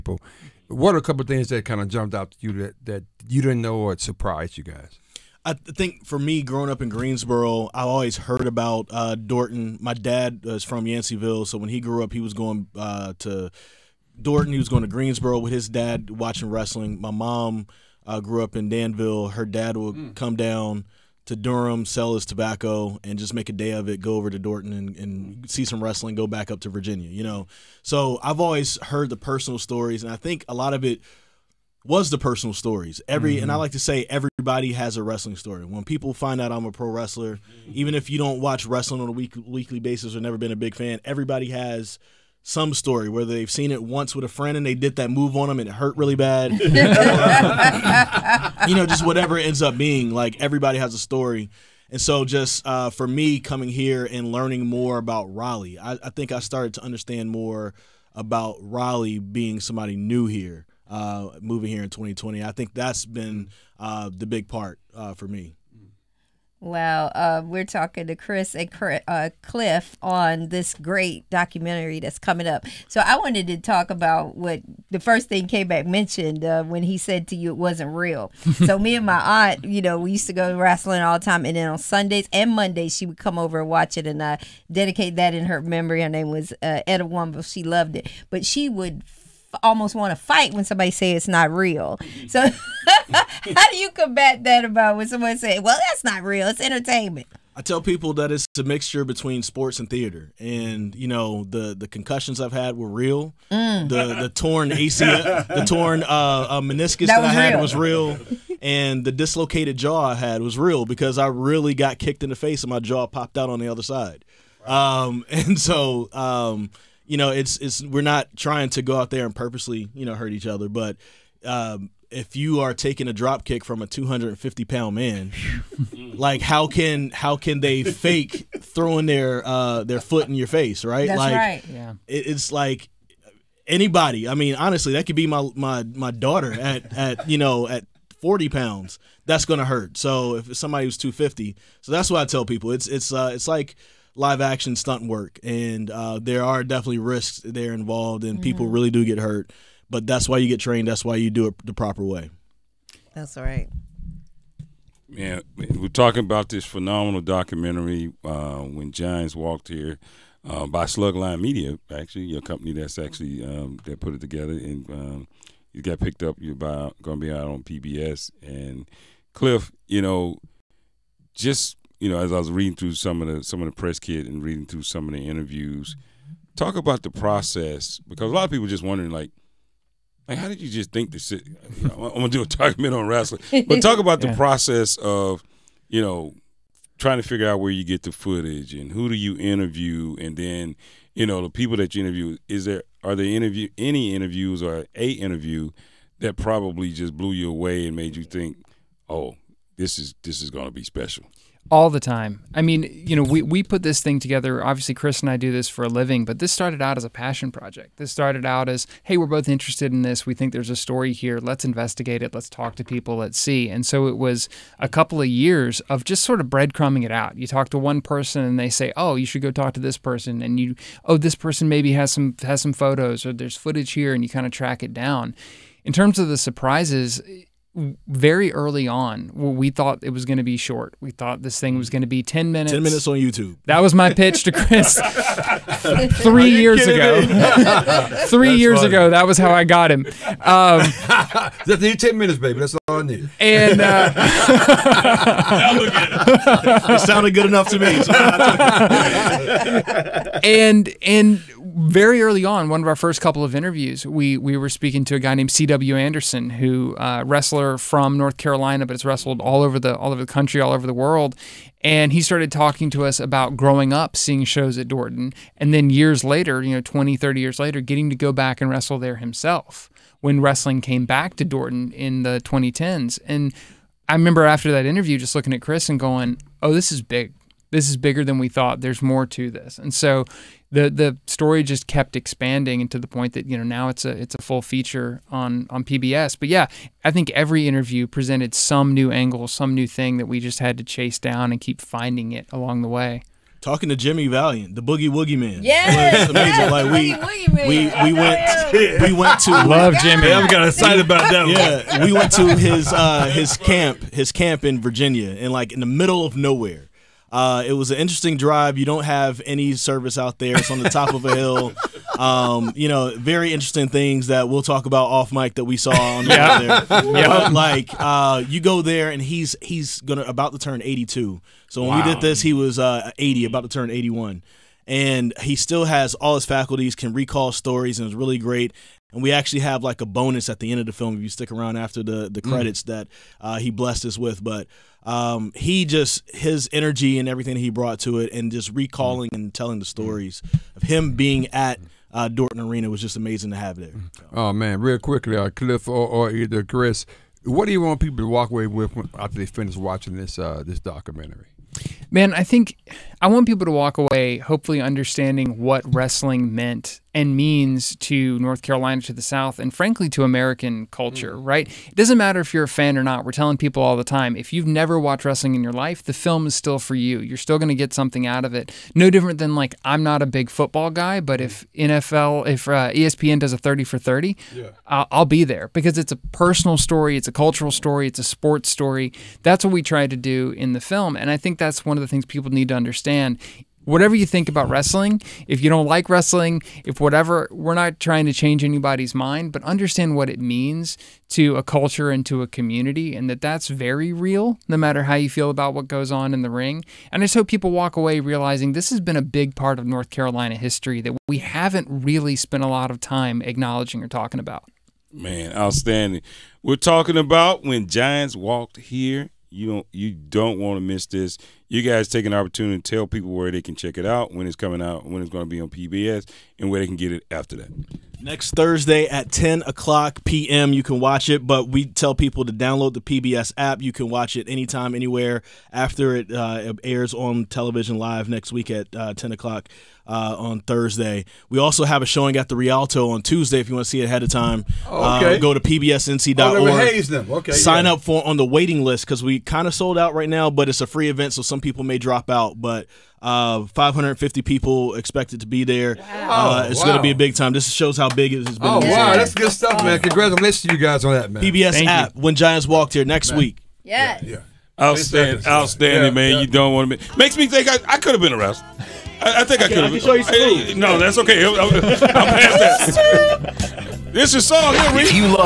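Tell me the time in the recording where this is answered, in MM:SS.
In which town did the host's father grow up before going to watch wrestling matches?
00:10.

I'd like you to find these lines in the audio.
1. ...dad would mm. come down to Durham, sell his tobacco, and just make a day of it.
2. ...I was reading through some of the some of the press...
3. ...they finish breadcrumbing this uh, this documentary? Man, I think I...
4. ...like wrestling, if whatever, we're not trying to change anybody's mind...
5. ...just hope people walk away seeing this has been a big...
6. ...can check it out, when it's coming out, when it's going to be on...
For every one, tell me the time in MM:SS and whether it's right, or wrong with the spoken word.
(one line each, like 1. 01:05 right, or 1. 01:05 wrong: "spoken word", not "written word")
1. 00:19 right
2. 02:52 right
3. 05:49 wrong: "watching", not "breadcrumbing"
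4. 06:25 right
5. 06:37 wrong: "realizing", not "seeing"
6. 06:53 right.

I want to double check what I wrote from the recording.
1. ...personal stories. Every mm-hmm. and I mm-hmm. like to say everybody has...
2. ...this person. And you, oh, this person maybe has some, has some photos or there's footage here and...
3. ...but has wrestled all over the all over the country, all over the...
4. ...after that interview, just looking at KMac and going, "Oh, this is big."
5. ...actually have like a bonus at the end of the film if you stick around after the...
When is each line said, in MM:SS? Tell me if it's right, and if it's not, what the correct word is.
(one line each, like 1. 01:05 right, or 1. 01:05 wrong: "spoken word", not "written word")
1. 00:32 right
2. 03:39 right
3. 04:18 right
4. 04:34 wrong: "Chris", not "KMac"
5. 05:29 right.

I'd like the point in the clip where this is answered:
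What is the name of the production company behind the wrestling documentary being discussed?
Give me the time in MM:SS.
02:40.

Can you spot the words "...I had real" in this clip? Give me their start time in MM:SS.
01:47.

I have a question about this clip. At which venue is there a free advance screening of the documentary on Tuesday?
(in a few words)
the Rialto.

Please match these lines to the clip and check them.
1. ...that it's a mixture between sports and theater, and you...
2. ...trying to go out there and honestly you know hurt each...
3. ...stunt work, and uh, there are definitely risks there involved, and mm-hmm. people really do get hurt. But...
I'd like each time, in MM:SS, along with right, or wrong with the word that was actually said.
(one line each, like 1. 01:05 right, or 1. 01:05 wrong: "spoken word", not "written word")
1. 01:38 right
2. 01:58 wrong: "purposely", not "honestly"
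3. 02:24 right.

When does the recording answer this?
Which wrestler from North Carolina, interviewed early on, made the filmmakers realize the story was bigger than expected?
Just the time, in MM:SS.
04:15.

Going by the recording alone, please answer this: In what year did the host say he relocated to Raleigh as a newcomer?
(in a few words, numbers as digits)
2020.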